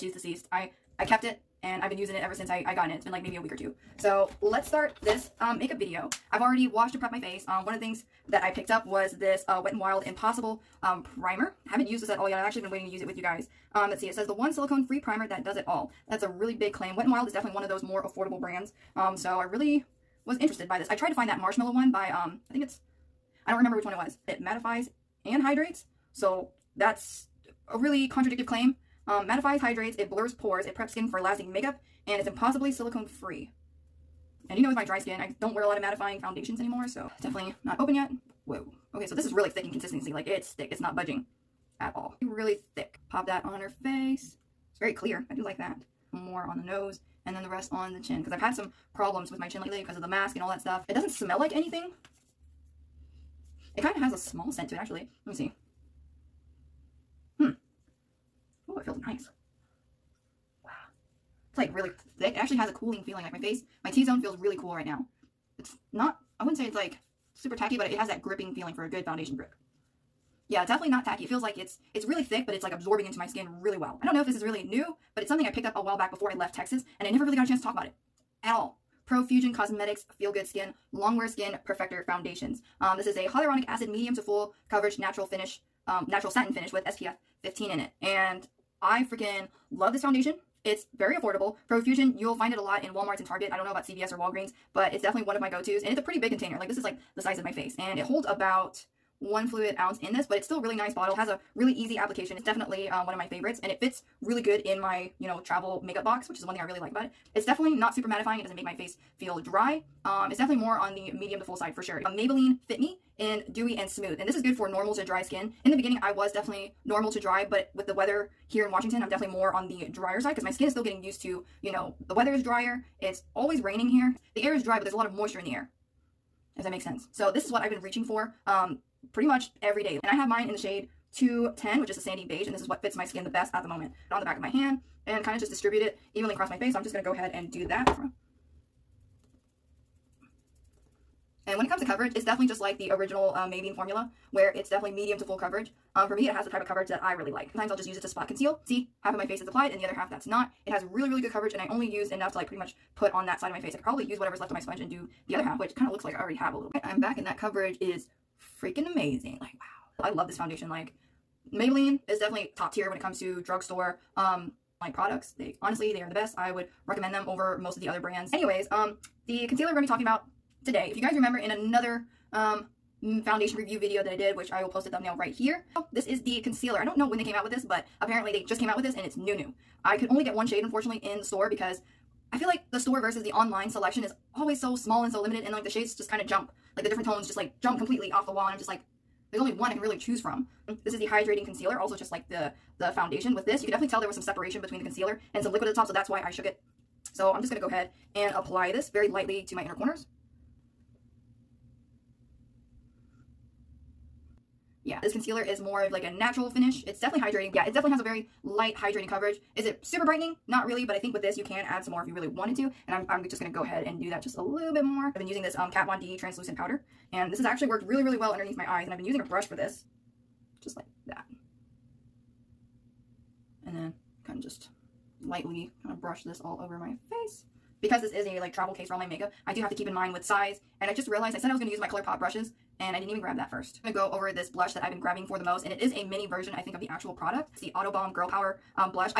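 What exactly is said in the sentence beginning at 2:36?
I'm back and that coverage is freaking amazing.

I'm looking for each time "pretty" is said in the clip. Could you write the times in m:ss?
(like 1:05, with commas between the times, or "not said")
1:36, 2:09, 2:32.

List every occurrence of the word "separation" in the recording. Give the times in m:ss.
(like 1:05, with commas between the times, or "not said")
3:14.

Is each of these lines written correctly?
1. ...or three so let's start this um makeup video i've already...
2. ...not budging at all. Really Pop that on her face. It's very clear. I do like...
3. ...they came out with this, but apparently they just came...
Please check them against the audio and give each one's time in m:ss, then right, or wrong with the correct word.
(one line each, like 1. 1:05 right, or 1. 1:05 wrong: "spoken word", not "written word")
1. 0:03 wrong: "two", not "three"
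2. 0:40 right
3. 2:57 right.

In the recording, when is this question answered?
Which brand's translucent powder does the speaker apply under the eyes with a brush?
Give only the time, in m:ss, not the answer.
3:35.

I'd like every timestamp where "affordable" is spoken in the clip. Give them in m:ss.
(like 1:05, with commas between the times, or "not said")
0:18, 1:31.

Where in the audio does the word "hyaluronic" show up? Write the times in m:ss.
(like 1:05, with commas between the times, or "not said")
1:23.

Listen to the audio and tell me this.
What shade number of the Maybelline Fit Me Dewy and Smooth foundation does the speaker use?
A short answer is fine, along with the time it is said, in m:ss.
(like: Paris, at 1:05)
210, at 2:11.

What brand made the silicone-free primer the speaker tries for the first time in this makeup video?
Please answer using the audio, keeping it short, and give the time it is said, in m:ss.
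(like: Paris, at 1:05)
Wet n Wild, at 0:16.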